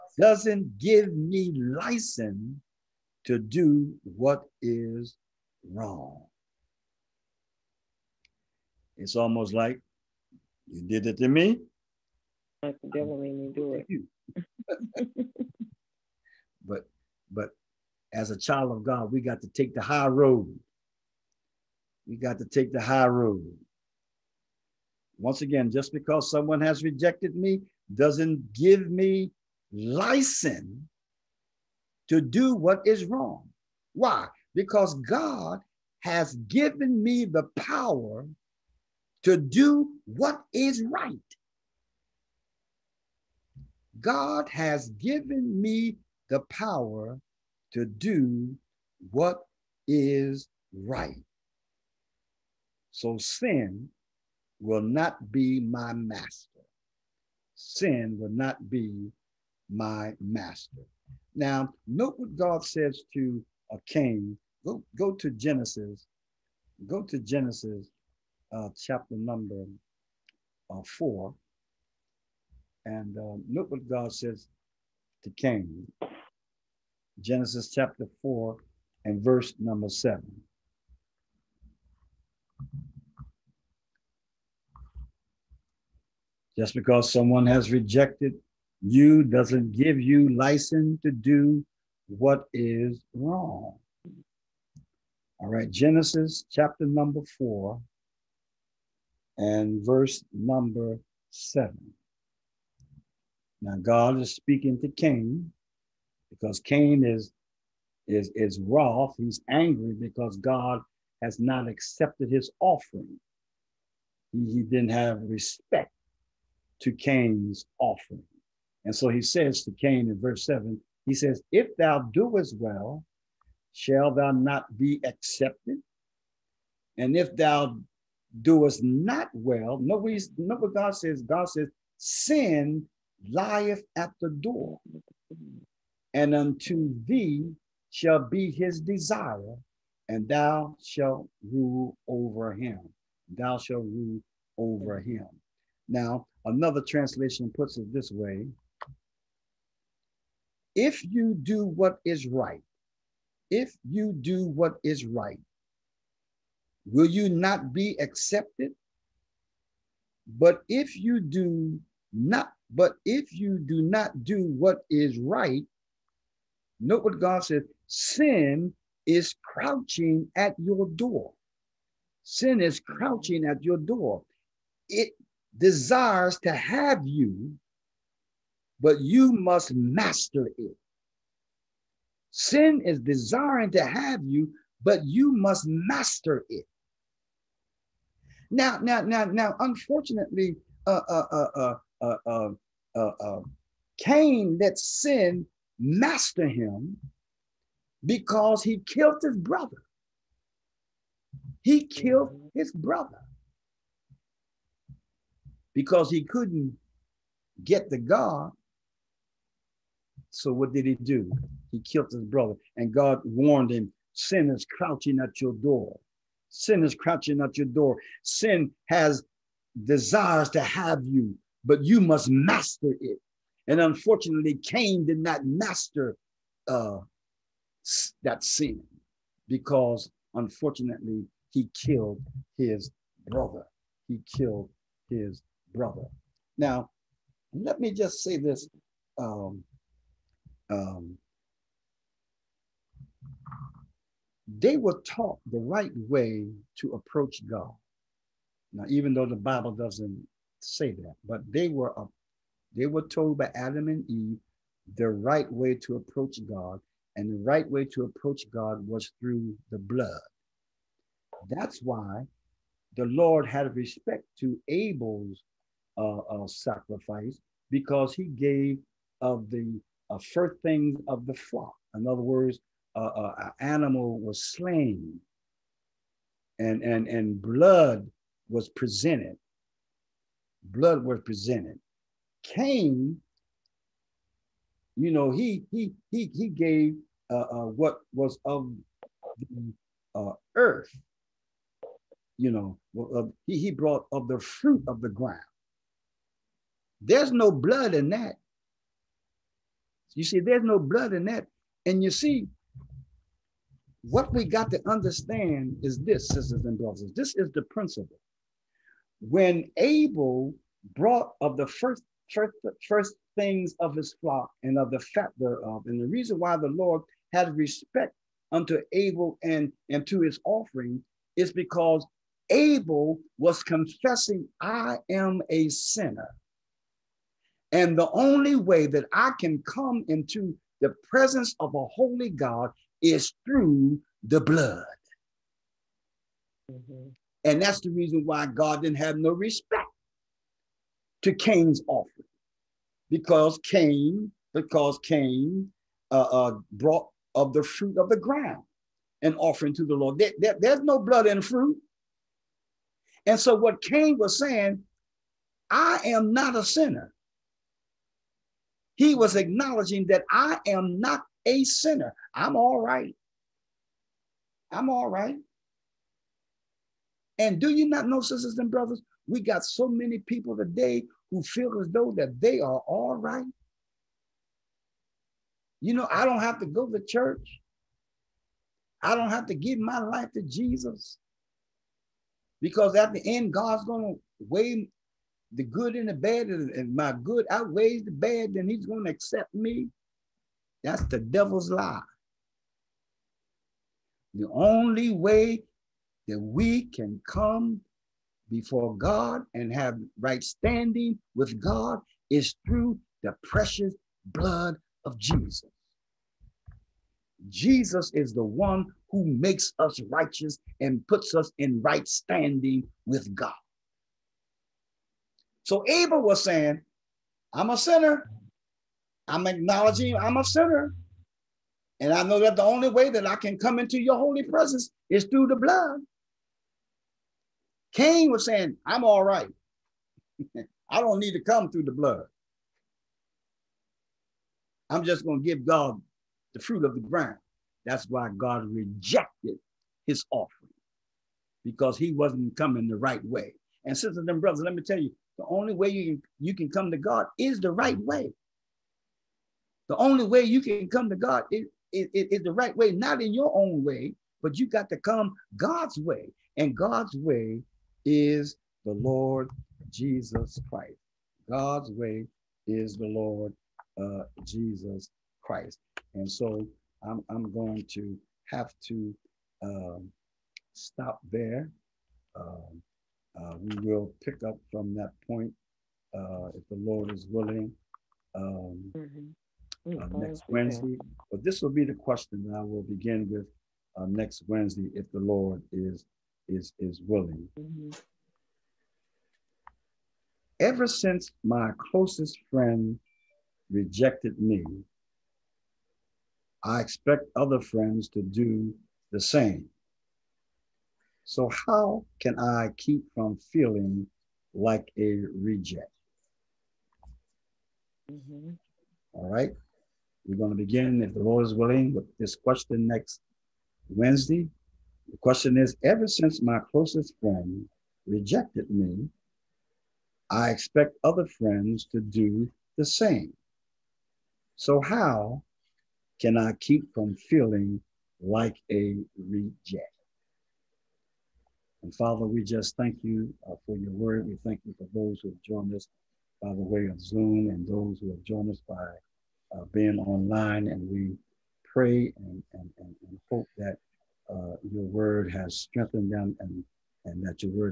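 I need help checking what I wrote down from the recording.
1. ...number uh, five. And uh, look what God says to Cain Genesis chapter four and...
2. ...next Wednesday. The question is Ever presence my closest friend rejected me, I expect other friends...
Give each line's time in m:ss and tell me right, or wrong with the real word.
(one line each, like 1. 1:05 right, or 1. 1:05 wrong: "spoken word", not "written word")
1. 1:09 wrong: "four", not "five"
2. 8:32 wrong: "since", not "presence".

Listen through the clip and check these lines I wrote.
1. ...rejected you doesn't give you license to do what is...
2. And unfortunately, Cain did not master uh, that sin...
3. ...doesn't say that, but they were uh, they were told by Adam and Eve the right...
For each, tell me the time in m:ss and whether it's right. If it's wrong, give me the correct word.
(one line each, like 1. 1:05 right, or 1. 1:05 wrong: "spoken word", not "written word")
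1. 1:27 right
2. 3:43 right
3. 4:09 right.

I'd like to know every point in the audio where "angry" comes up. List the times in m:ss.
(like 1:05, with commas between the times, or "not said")
1:49.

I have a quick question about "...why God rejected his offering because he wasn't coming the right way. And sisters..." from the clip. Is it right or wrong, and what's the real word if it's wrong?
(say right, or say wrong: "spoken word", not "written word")
right.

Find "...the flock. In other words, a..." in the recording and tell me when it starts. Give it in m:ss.
4:31.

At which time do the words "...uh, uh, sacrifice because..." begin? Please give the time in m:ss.
4:25.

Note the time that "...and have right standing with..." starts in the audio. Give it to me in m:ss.
6:39.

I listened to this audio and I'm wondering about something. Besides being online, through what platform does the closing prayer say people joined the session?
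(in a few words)
Zoom.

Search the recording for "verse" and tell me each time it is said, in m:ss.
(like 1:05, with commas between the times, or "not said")
1:19, 1:39, 2:00.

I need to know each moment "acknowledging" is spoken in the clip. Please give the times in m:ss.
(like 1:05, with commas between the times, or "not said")
5:59, 6:59.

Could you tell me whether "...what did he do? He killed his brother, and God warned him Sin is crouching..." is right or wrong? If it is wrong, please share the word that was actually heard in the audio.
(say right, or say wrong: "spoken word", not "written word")
right.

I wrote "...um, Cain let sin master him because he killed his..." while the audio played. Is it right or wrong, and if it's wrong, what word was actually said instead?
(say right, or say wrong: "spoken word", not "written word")
right.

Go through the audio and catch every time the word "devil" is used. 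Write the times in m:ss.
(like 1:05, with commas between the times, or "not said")
0:12, 6:31.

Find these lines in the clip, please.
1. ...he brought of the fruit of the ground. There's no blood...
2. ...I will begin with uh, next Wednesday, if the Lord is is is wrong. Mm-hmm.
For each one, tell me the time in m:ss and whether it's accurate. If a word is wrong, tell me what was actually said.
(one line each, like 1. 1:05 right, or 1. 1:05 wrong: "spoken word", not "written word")
1. 4:53 right
2. 8:02 wrong: "willing", not "wrong".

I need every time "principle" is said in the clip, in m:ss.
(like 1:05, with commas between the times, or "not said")
5:07.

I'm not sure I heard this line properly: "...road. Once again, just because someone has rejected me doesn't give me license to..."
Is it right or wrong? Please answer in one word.
right.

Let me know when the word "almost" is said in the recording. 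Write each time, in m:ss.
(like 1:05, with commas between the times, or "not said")
0:09.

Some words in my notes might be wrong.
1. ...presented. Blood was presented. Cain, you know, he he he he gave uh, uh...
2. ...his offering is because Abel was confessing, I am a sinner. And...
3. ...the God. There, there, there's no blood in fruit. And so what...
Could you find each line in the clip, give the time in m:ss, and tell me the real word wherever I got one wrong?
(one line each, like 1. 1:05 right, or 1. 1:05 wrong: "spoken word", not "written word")
1. 4:38 right
2. 5:20 right
3. 5:49 wrong: "Lord", not "God".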